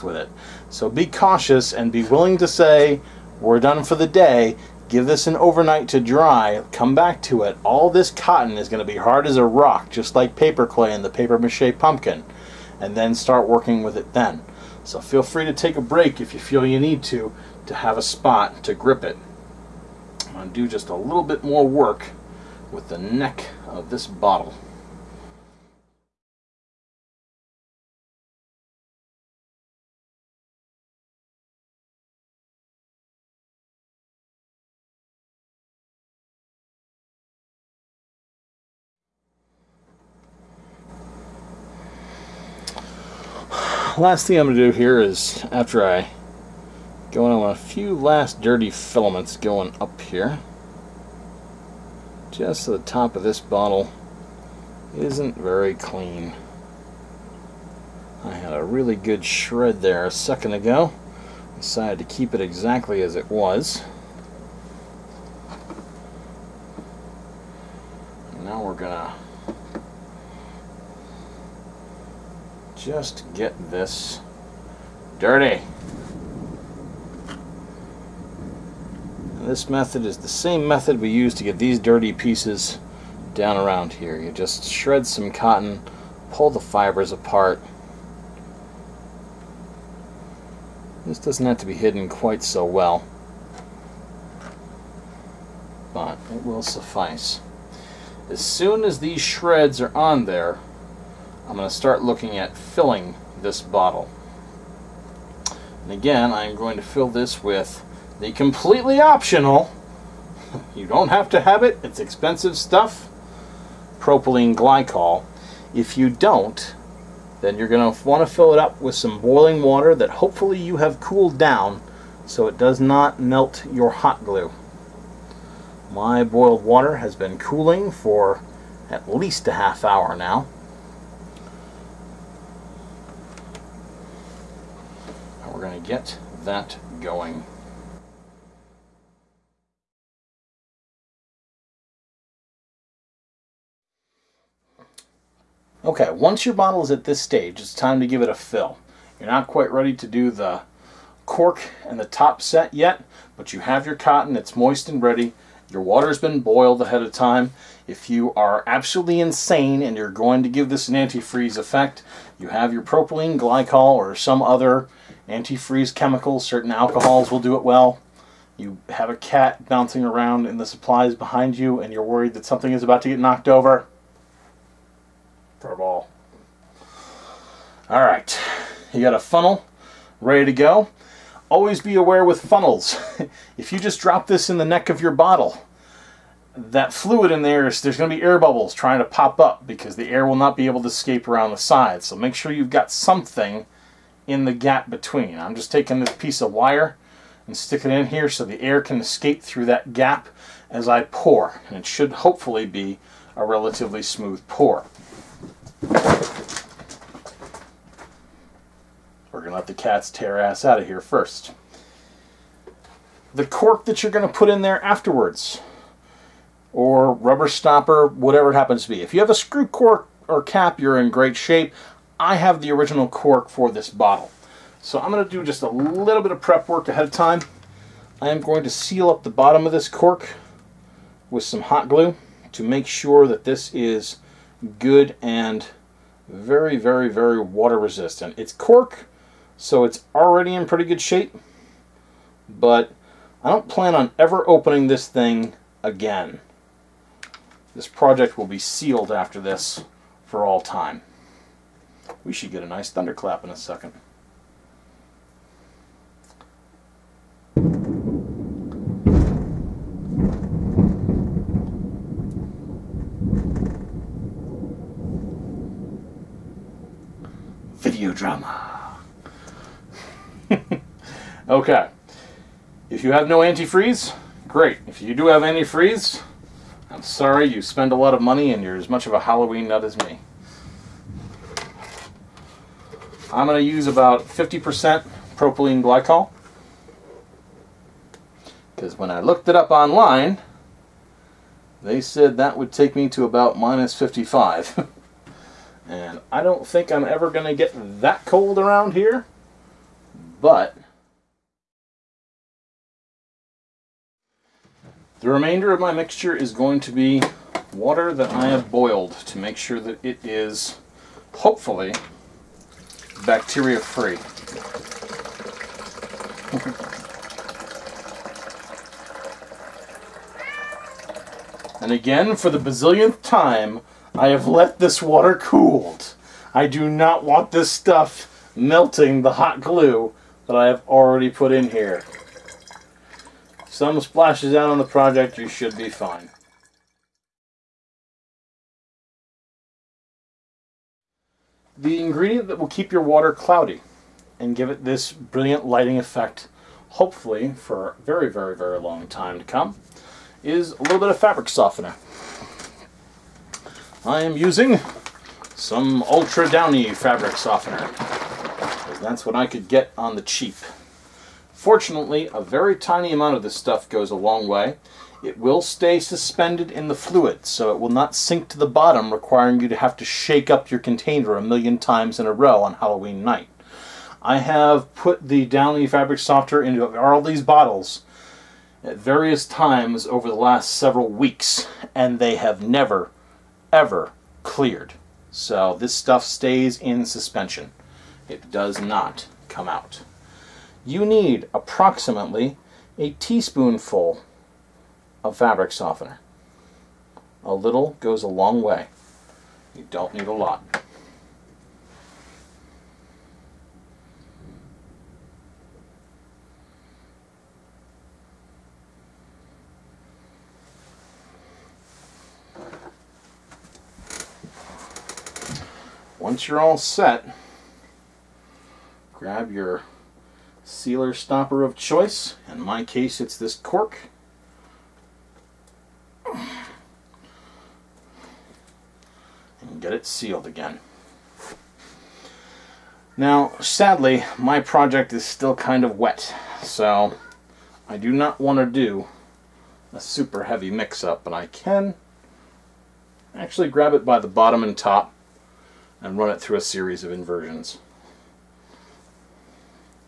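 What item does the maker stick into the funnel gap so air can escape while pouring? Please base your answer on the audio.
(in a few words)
piece of wire.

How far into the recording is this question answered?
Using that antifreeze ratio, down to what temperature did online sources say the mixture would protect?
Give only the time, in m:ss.
4:53.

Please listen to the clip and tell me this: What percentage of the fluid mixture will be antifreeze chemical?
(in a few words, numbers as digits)
50%.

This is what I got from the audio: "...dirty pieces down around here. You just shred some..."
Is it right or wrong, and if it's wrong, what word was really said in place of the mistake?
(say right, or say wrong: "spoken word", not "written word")
right.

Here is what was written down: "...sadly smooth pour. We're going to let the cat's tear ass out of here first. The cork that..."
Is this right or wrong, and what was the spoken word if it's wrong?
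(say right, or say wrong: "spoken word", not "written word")
wrong: "relatively", not "sadly".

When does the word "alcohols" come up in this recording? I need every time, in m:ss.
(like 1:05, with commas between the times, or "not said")
2:46.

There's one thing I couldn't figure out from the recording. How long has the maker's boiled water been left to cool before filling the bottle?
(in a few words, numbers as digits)
at least a half hour.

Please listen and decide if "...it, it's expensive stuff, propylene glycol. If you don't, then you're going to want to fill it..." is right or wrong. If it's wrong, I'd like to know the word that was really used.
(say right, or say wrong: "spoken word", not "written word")
right.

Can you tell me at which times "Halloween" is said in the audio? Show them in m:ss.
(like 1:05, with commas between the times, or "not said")
4:39, 6:12.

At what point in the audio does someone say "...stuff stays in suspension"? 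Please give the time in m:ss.
6:25.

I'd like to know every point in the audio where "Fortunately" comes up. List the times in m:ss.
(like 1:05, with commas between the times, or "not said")
6:01.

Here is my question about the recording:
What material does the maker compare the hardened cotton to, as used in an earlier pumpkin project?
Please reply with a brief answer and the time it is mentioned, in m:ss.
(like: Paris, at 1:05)
paper clay, at 0:10.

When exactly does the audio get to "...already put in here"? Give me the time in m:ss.
5:30.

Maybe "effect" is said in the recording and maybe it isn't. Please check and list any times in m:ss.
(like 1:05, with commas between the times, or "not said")
2:41, 5:45.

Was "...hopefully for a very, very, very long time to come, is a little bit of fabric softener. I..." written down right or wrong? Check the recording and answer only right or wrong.
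right.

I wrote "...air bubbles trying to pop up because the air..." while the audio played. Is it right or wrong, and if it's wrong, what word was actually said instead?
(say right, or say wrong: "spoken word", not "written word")
right.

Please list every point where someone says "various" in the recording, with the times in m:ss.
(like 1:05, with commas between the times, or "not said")
6:18.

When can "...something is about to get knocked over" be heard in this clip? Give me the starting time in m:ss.
2:52.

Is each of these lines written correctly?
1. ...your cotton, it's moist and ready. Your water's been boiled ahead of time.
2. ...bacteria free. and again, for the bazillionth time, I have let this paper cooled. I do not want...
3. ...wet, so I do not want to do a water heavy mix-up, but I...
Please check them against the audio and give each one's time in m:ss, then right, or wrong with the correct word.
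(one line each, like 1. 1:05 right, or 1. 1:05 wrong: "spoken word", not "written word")
1. 2:33 right
2. 5:13 wrong: "water", not "paper"
3. 7:15 wrong: "super", not "water".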